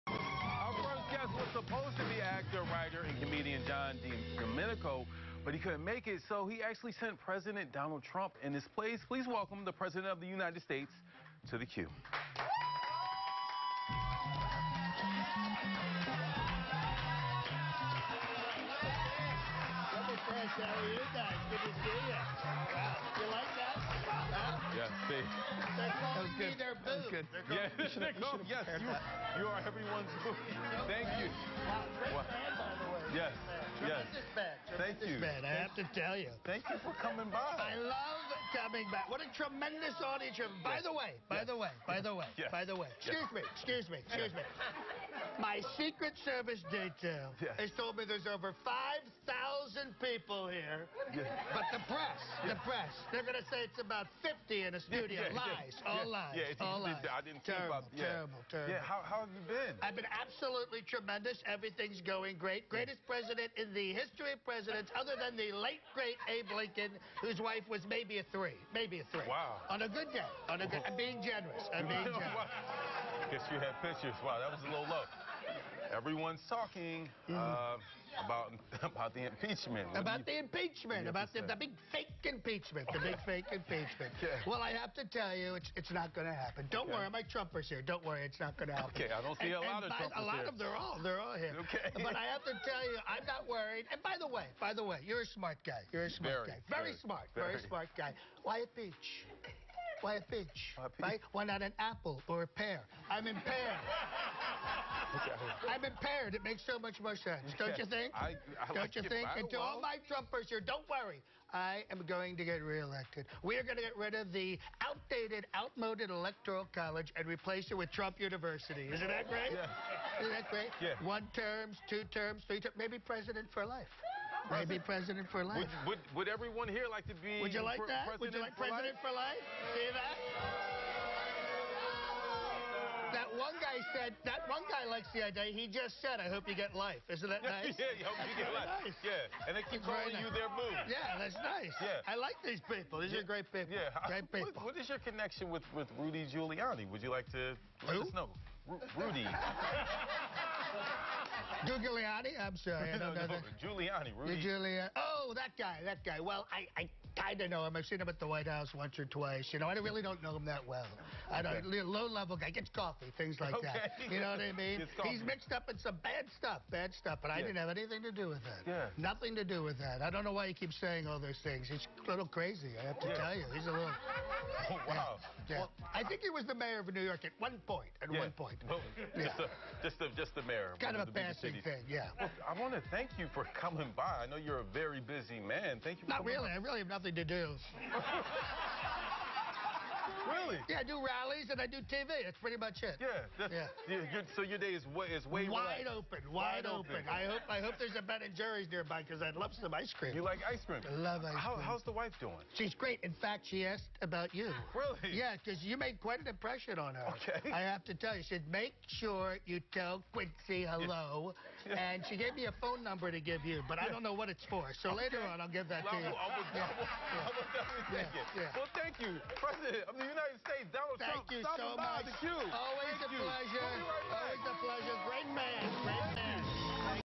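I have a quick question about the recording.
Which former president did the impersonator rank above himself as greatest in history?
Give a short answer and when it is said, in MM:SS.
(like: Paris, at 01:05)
Abe Lincoln, at 01:06.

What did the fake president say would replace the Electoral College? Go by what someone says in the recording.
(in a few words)
Trump University.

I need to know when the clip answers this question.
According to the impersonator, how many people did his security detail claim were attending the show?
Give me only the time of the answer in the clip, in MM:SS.
00:48.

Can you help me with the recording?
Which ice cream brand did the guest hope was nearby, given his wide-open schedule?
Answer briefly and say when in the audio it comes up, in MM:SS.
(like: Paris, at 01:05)
Ben and Jerry's, at 03:18.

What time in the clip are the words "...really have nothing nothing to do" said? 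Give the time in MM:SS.
03:06.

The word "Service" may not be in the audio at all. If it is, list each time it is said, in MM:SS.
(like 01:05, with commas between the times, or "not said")
00:46.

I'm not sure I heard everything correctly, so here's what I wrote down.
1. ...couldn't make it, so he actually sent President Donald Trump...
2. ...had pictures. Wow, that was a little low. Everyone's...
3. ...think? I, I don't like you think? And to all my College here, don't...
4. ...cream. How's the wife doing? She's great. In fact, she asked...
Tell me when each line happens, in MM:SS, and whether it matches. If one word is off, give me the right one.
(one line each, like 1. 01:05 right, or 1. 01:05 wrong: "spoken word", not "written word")
1. 00:05 right
2. 01:13 right
3. 01:47 wrong: "Trumpers", not "College"
4. 03:21 right.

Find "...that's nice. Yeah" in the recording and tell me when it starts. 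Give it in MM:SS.
02:21.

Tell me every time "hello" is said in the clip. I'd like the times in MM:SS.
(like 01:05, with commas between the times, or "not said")
03:30.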